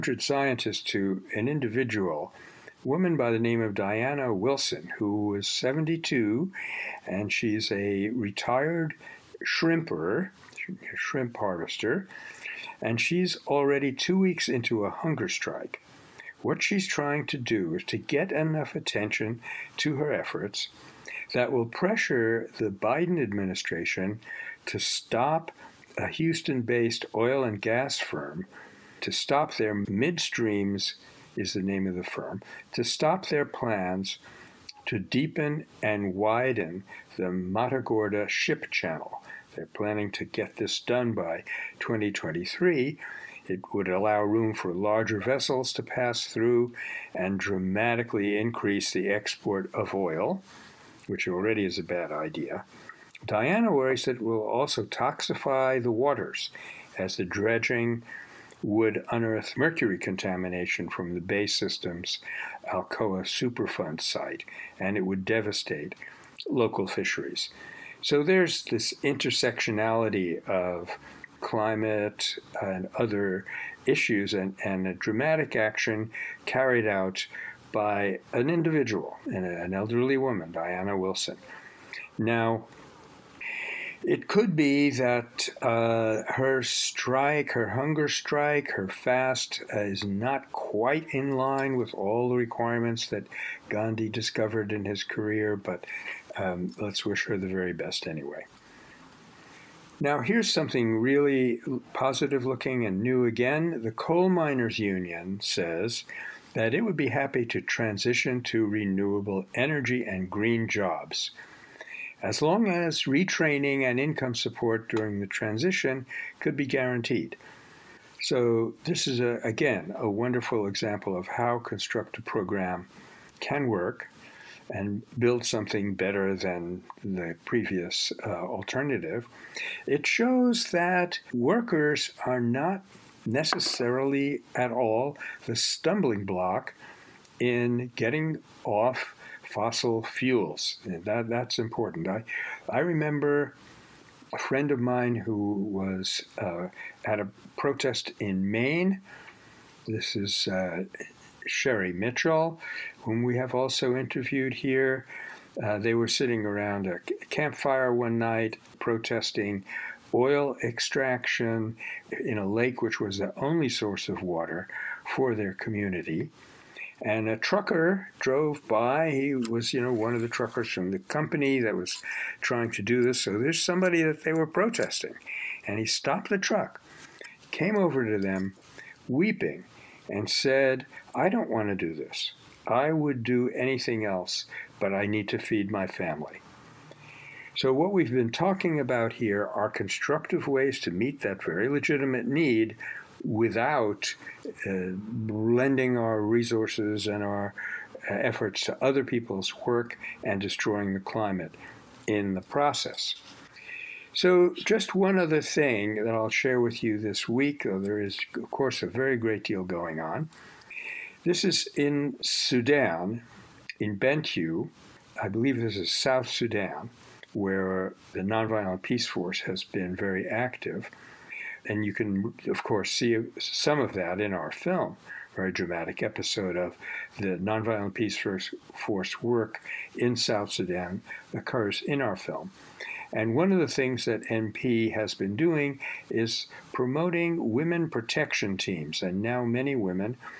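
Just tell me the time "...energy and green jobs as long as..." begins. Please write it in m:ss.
1:49.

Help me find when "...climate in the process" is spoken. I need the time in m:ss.
3:20.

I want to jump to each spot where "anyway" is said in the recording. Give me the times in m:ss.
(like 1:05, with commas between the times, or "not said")
1:38.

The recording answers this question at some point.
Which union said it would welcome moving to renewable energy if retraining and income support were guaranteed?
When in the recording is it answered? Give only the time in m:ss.
1:43.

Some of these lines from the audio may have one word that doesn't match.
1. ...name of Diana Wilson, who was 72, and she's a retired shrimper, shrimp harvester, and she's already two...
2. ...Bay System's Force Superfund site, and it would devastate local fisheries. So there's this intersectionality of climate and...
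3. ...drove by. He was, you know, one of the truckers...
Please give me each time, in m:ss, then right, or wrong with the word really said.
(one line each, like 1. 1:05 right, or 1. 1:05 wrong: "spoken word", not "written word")
1. 0:03 right
2. 1:01 wrong: "Alcoa", not "Force"
3. 2:48 right.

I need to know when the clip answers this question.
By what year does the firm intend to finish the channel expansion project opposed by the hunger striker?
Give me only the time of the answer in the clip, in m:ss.
0:41.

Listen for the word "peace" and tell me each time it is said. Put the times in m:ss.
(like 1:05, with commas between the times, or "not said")
3:38, 3:47.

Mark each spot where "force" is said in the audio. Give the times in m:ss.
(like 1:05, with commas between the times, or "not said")
3:39, 3:48.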